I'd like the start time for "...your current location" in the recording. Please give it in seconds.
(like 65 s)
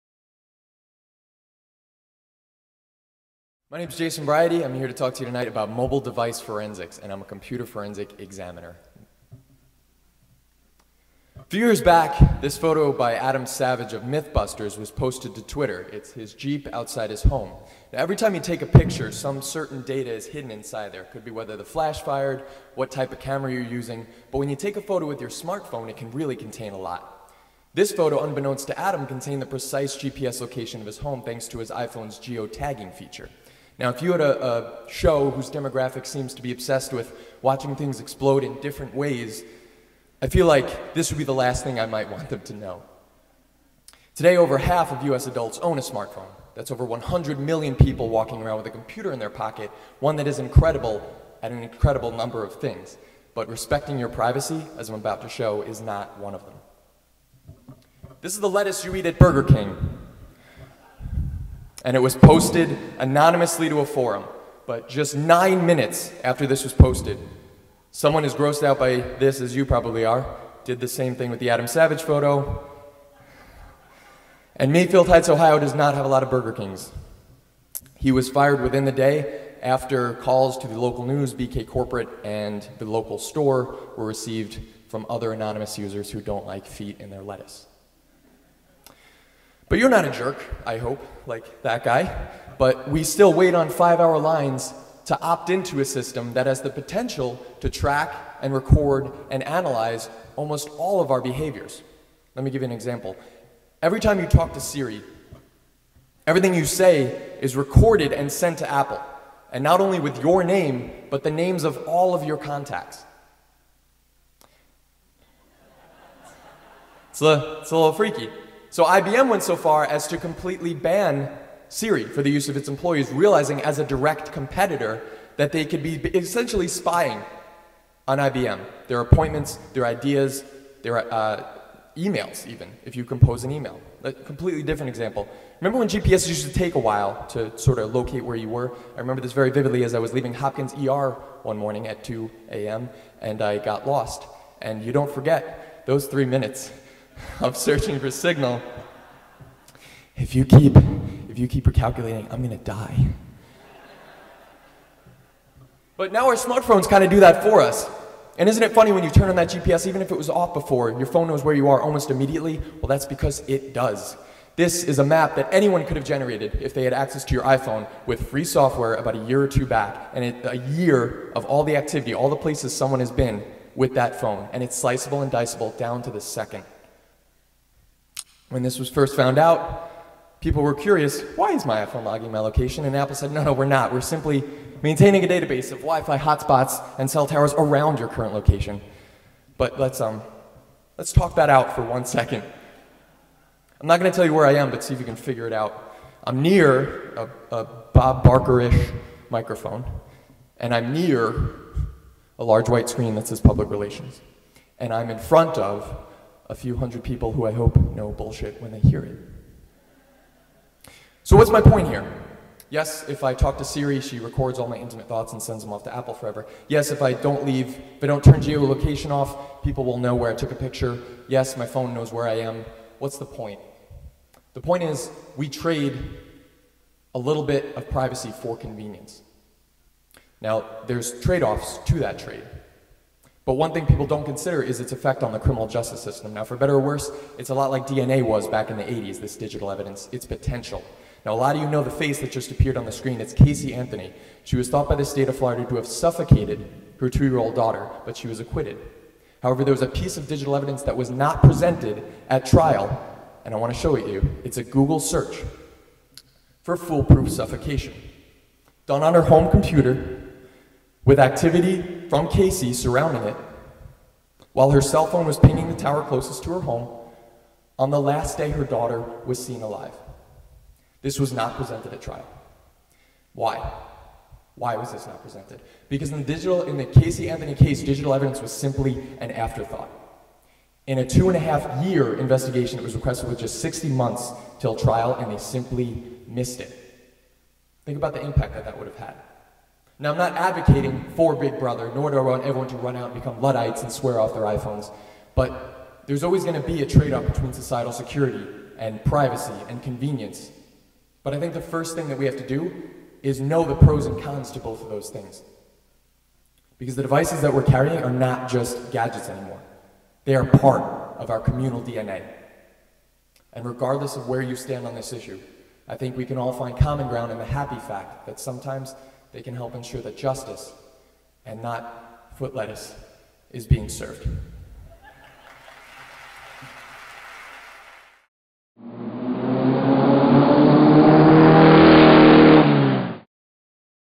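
187 s.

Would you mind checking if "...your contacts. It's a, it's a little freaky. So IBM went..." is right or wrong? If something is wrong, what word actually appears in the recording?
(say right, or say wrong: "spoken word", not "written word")
right.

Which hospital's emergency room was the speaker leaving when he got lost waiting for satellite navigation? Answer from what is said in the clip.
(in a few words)
Hopkins.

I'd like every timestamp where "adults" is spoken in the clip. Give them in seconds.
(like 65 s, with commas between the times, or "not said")
45 s.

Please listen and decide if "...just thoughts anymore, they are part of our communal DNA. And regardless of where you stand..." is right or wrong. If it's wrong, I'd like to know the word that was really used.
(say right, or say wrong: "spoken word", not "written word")
wrong: "gadgets", not "thoughts".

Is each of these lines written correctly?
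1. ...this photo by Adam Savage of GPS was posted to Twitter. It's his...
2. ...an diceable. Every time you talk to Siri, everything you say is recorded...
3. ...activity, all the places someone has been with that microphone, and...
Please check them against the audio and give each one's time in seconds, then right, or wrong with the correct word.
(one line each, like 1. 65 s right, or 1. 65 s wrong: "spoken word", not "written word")
1. 12 s wrong: "Mythbusters", not "GPS"
2. 102 s wrong: "example", not "diceable"
3. 171 s wrong: "phone", not "microphone".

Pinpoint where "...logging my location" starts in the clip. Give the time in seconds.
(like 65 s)
182 s.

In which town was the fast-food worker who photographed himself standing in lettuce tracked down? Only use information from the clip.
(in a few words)
Mayfield Heights, Ohio.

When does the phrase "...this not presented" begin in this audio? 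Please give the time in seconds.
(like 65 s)
274 s.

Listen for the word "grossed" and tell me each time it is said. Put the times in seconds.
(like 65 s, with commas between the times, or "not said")
68 s.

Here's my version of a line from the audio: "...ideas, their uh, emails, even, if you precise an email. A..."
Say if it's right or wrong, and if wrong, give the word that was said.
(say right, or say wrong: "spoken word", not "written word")
wrong: "compose", not "precise".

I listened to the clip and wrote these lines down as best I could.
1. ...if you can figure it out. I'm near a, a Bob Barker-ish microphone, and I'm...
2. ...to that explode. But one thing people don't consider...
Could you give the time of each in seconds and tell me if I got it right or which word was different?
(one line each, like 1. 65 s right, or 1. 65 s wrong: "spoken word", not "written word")
1. 194 s right
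2. 231 s wrong: "trade", not "explode".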